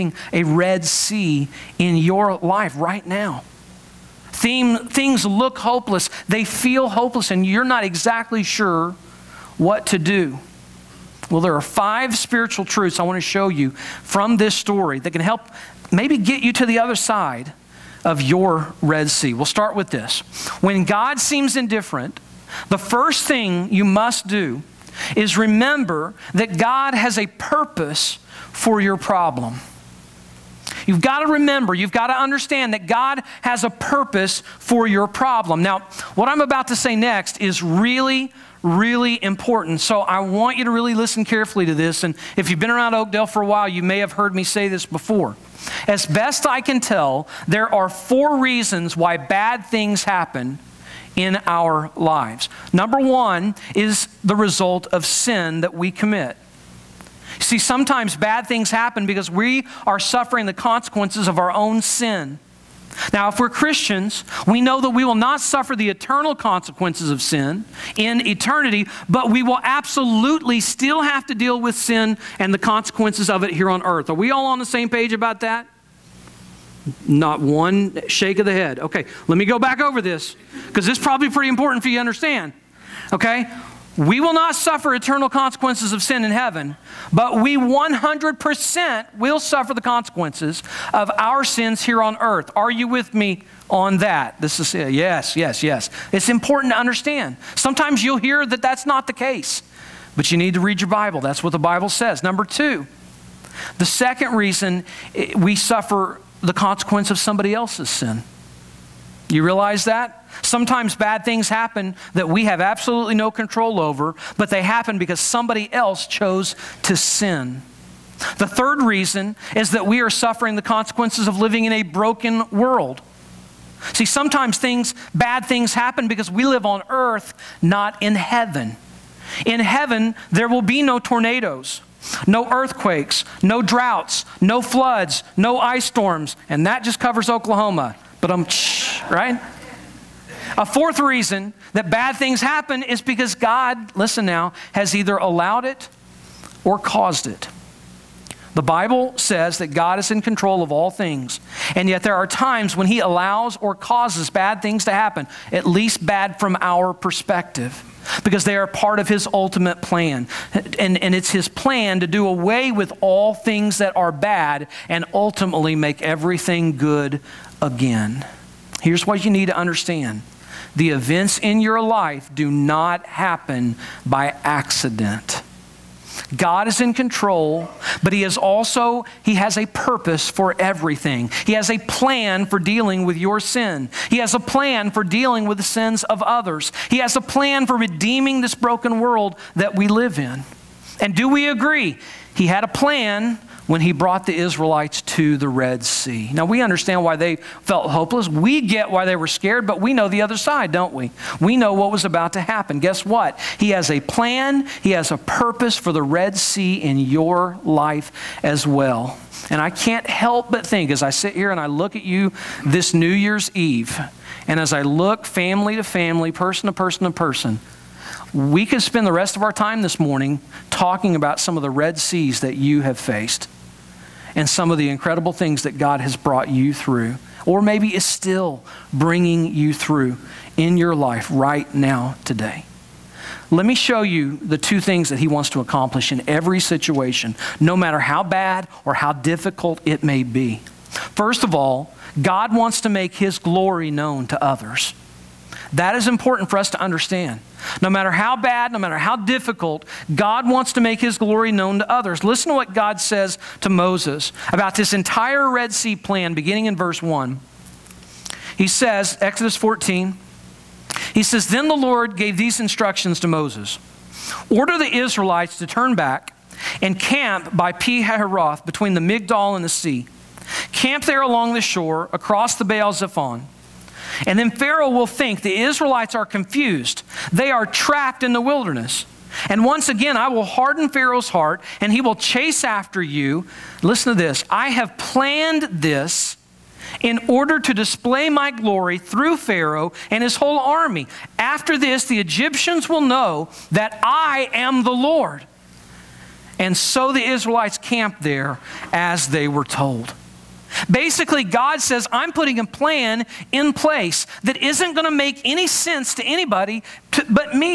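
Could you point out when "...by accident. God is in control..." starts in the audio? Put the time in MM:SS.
02:54.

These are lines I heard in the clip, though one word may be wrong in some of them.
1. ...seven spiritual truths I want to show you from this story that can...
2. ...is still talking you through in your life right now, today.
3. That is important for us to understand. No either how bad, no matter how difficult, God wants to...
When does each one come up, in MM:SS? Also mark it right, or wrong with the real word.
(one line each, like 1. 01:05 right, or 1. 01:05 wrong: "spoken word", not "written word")
1. 00:11 wrong: "five", not "seven"
2. 03:47 wrong: "bringing", not "talking"
3. 04:05 wrong: "matter", not "either".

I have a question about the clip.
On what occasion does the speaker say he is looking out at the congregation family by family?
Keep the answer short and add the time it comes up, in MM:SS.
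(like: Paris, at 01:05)
New Year's Eve, at 03:32.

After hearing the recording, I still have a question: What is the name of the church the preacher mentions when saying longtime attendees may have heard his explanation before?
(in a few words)
Oakdale.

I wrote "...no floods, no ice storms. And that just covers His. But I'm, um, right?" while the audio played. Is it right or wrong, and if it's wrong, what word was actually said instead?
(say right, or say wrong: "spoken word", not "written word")
wrong: "Oklahoma", not "His".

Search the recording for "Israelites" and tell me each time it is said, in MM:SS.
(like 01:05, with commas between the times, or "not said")
03:14, 04:24, 04:35, 04:57.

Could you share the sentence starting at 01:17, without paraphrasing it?
Not one shake of the head.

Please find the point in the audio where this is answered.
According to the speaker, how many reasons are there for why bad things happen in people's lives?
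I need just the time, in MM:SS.
00:47.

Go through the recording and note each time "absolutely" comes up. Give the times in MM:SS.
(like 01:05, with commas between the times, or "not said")
01:09, 01:52.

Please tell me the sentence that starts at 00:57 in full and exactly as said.
See, sometimes bad things happen because we are suffering the consequences of our own sin.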